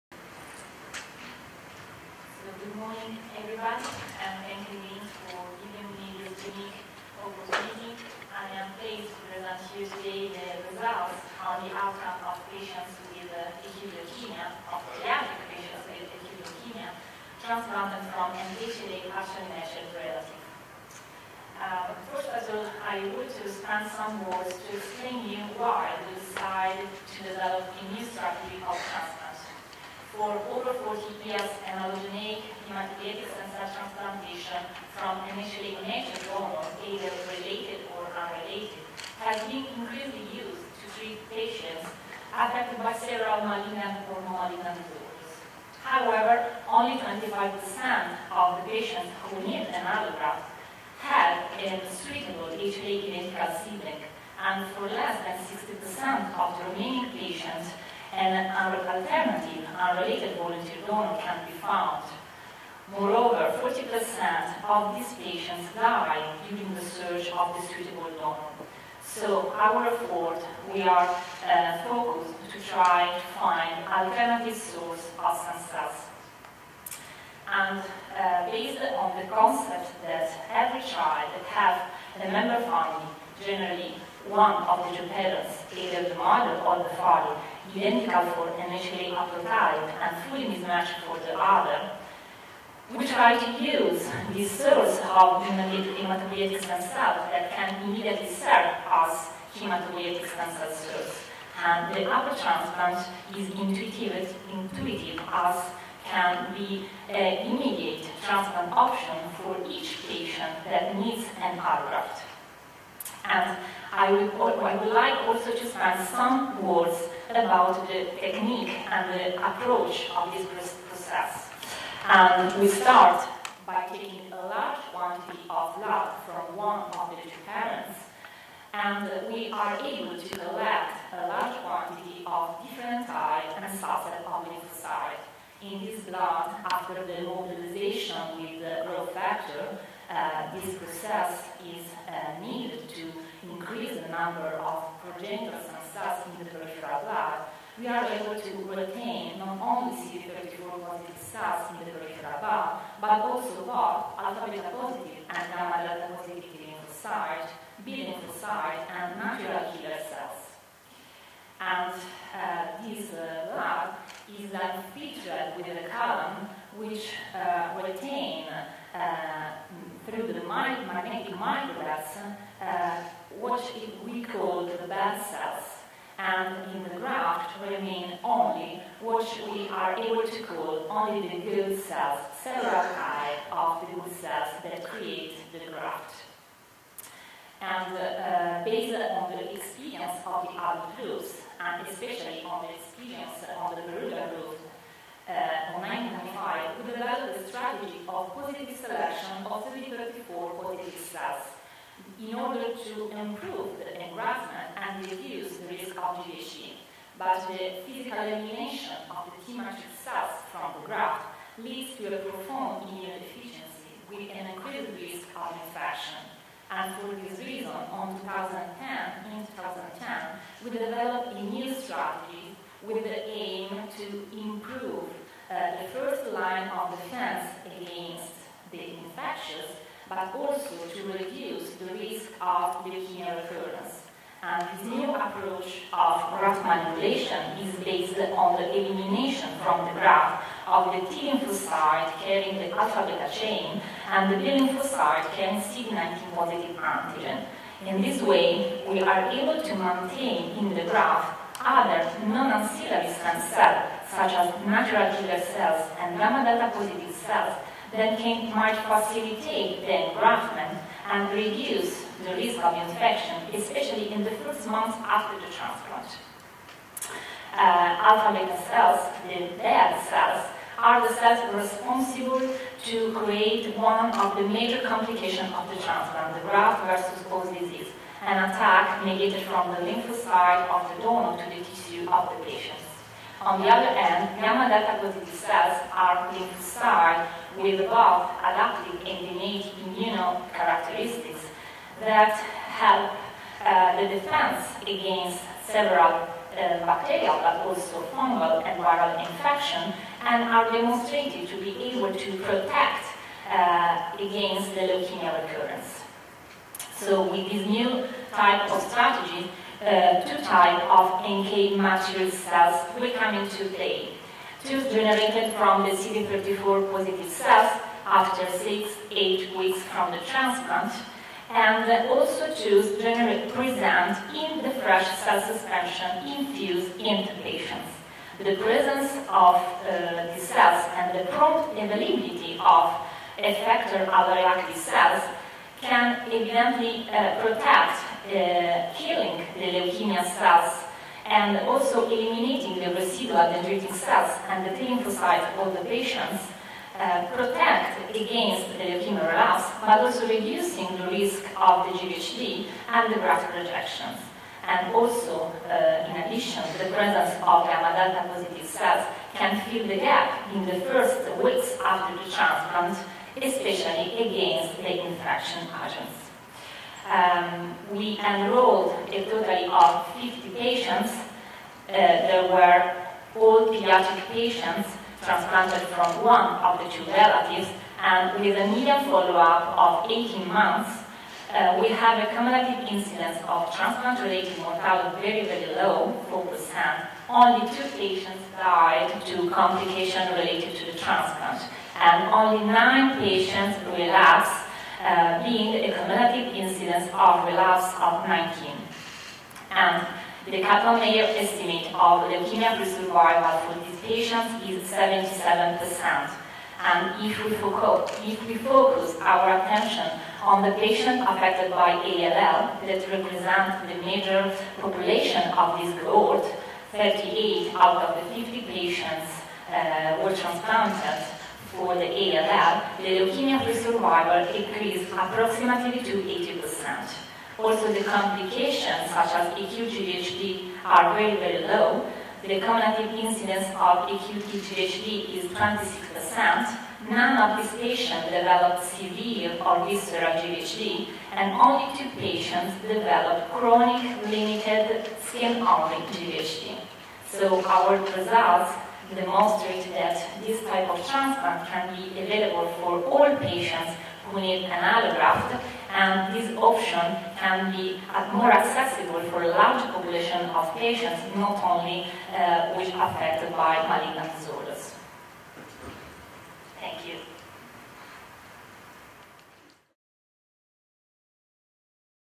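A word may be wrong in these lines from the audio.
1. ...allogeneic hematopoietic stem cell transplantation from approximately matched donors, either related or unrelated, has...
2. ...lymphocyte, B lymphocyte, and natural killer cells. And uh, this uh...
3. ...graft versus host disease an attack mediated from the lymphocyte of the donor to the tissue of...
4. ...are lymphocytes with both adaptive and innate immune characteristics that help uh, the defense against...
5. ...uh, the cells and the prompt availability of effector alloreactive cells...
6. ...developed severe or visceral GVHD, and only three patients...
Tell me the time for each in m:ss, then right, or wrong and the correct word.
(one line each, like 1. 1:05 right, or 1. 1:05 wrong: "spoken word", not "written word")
1. 0:31 wrong: "initially", not "approximately"
2. 2:36 right
3. 4:36 right
4. 4:45 right
5. 5:29 right
6. 7:18 wrong: "two", not "three".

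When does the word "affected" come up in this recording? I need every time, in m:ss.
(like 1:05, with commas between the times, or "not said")
0:42, 6:51, 7:42.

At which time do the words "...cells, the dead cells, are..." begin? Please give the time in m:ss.
4:28.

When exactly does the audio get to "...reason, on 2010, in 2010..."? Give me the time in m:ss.
3:37.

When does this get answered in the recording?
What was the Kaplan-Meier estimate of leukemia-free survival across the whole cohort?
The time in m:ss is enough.
6:44.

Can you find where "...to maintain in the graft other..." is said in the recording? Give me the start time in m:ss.
4:09.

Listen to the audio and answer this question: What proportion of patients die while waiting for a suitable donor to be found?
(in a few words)
40%.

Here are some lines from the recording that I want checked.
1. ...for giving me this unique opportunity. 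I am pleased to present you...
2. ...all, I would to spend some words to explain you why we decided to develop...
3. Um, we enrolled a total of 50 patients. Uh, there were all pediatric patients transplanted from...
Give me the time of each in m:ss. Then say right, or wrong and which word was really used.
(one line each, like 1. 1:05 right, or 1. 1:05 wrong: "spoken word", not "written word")
1. 0:05 right
2. 0:22 right
3. 6:07 right.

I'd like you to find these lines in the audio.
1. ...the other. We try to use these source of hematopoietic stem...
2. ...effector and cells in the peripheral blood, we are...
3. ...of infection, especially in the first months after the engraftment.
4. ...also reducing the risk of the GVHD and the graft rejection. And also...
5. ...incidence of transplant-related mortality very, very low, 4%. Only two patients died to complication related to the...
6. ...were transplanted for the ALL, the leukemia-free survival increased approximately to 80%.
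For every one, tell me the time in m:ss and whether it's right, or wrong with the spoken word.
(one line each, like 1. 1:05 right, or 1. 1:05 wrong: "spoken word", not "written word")
1. 1:31 right
2. 2:24 wrong: "progenitor", not "effector"
3. 4:22 wrong: "transplant", not "engraftment"
4. 5:49 right
5. 6:22 right
6. 7:00 right.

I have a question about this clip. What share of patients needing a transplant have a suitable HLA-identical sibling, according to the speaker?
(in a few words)
25%.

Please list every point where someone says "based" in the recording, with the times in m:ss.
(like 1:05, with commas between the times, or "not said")
1:18, 3:08, 3:57.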